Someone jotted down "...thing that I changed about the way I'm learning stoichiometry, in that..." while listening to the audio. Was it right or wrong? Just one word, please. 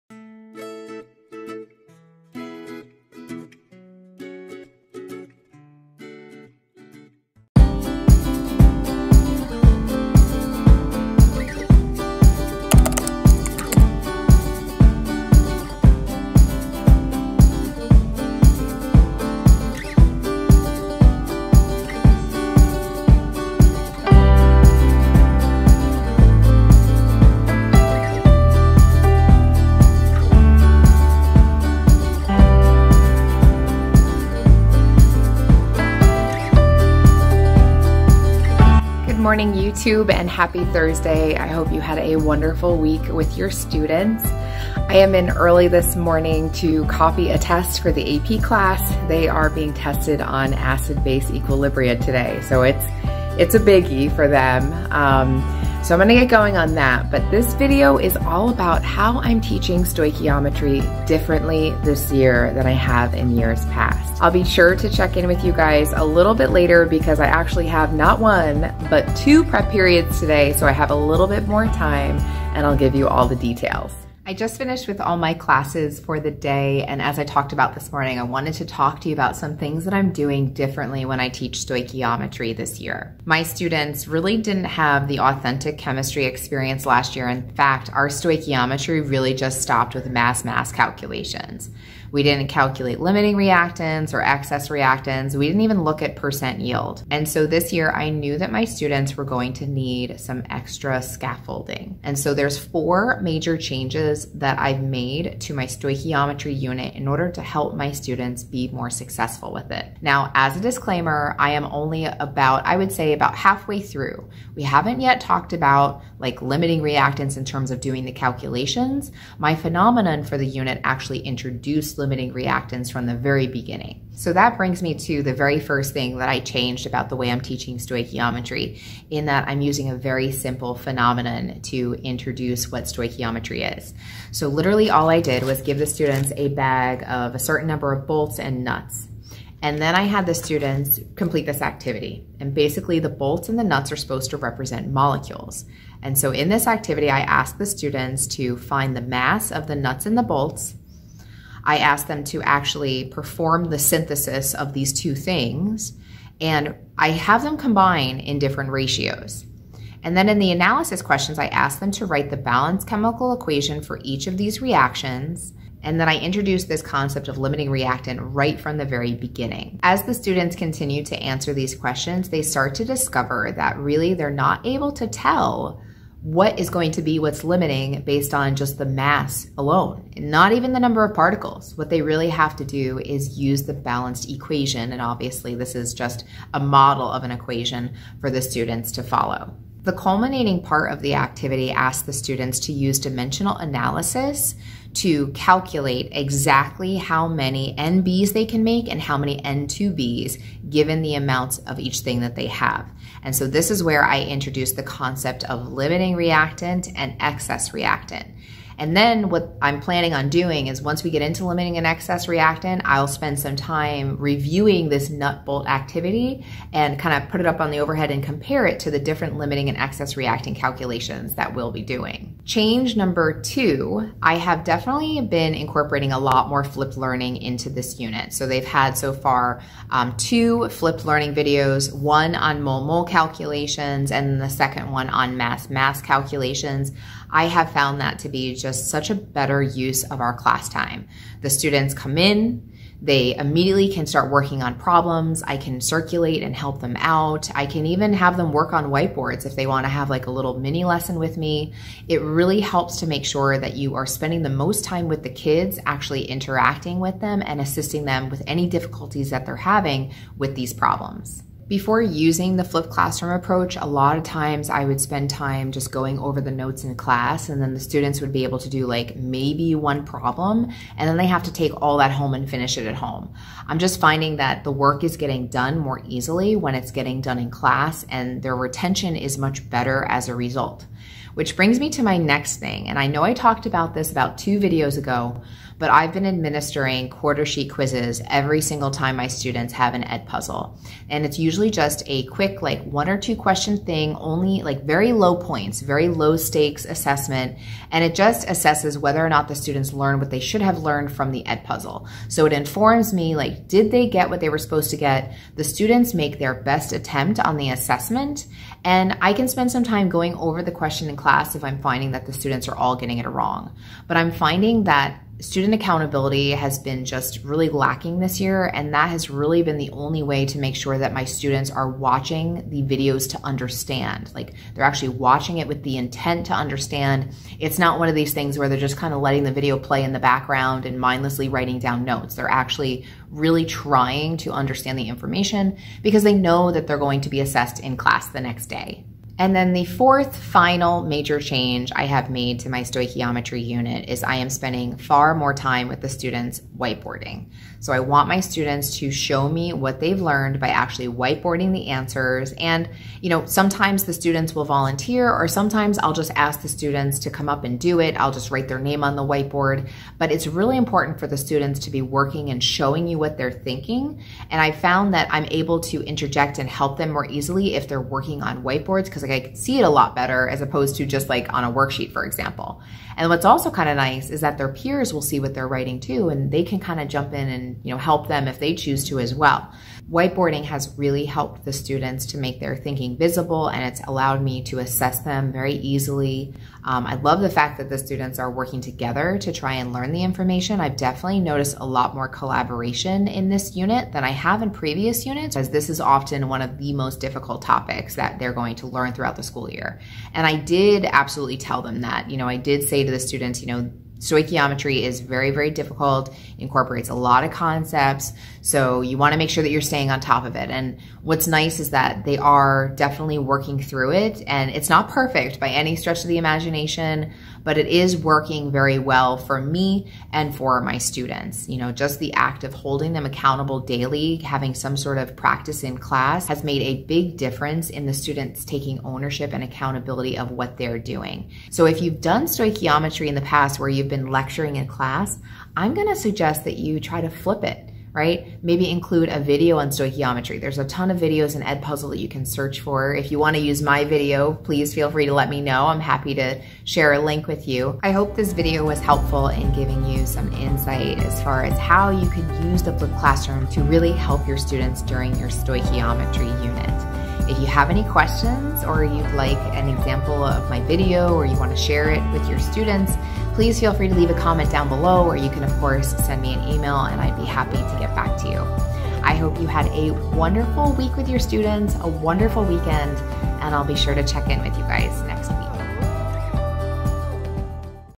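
wrong.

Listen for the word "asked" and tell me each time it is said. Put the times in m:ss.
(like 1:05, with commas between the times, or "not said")
2:27, 2:31.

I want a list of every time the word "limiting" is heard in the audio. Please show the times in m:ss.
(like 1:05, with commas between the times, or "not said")
1:32, 1:56, 2:01, 2:47, 2:57, 3:25, 3:31, 3:39.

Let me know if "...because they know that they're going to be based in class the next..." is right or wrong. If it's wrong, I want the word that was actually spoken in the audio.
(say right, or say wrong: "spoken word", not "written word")
wrong: "assessed", not "based".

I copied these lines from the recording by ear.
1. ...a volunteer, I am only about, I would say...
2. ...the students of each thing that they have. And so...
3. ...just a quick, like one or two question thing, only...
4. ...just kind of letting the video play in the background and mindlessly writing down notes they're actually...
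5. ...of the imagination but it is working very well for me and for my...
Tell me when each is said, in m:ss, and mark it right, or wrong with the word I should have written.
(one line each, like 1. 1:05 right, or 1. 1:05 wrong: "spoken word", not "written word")
1. 1:50 wrong: "disclaimer", not "volunteer"
2. 3:21 wrong: "amounts", not "students"
3. 4:51 right
4. 5:28 right
5. 6:56 right.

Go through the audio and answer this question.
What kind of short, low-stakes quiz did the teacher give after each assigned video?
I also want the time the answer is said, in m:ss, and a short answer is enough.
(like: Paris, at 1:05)
quarter sheet quizzes, at 4:47.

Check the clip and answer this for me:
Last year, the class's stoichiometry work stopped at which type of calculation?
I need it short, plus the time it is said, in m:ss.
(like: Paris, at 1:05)
mass mass calculations, at 1:30.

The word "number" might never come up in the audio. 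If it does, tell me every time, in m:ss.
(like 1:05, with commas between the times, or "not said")
2:17, 3:00, 3:42.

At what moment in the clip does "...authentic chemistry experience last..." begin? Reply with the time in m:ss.
1:25.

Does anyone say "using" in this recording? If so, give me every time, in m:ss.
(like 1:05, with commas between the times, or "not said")
2:09, 4:22.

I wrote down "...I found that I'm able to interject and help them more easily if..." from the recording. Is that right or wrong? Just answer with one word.
right.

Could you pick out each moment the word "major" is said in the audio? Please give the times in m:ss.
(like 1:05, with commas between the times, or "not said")
1:43, 5:41.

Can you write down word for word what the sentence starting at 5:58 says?
I'll just write their name on the whiteboard.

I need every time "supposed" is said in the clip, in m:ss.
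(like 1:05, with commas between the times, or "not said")
2:23, 5:04.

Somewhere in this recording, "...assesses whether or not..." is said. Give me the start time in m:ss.
4:58.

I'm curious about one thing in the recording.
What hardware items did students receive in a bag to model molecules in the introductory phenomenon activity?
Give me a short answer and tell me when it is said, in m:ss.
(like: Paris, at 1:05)
bolts and nuts, at 2:18.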